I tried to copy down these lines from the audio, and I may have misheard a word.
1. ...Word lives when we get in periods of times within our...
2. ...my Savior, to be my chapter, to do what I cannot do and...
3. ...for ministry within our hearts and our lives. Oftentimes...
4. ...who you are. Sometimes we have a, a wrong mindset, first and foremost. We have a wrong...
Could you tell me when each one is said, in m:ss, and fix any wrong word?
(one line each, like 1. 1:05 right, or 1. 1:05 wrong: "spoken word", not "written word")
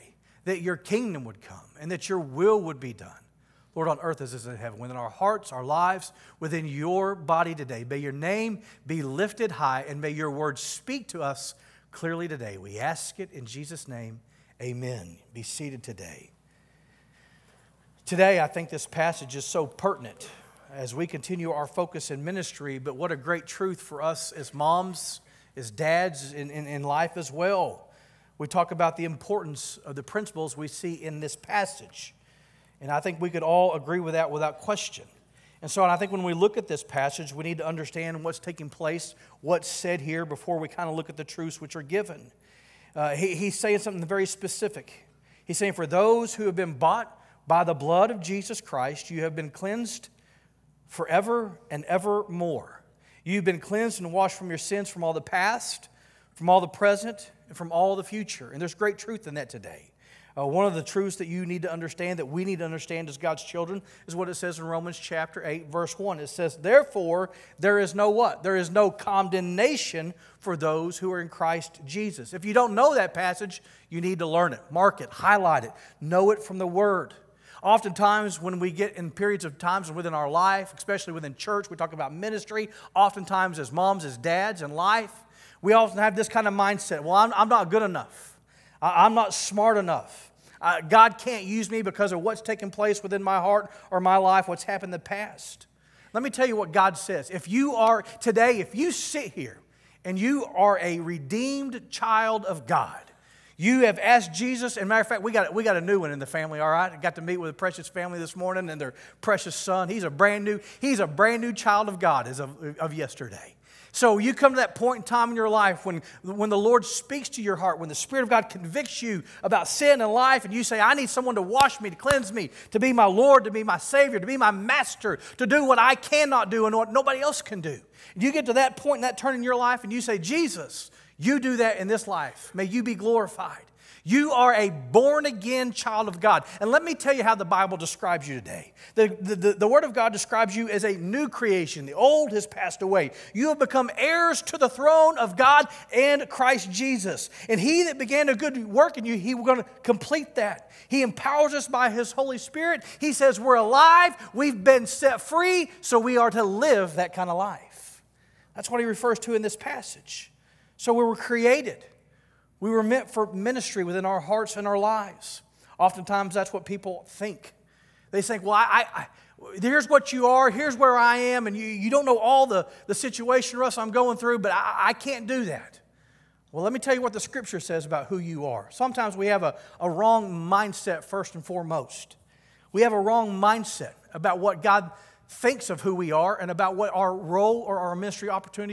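1. 1:16 wrong: "oftentimes", not "lives"
2. 2:03 wrong: "master", not "chapter"
3. 2:43 right
4. 2:58 right.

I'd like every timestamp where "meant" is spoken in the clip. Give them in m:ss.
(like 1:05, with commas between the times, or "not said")
2:42.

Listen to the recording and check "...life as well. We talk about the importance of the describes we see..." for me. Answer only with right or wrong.
wrong.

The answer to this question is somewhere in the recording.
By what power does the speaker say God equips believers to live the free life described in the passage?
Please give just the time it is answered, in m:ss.
2:31.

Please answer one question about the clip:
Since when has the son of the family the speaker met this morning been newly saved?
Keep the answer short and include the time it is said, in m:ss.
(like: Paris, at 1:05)
yesterday, at 1:52.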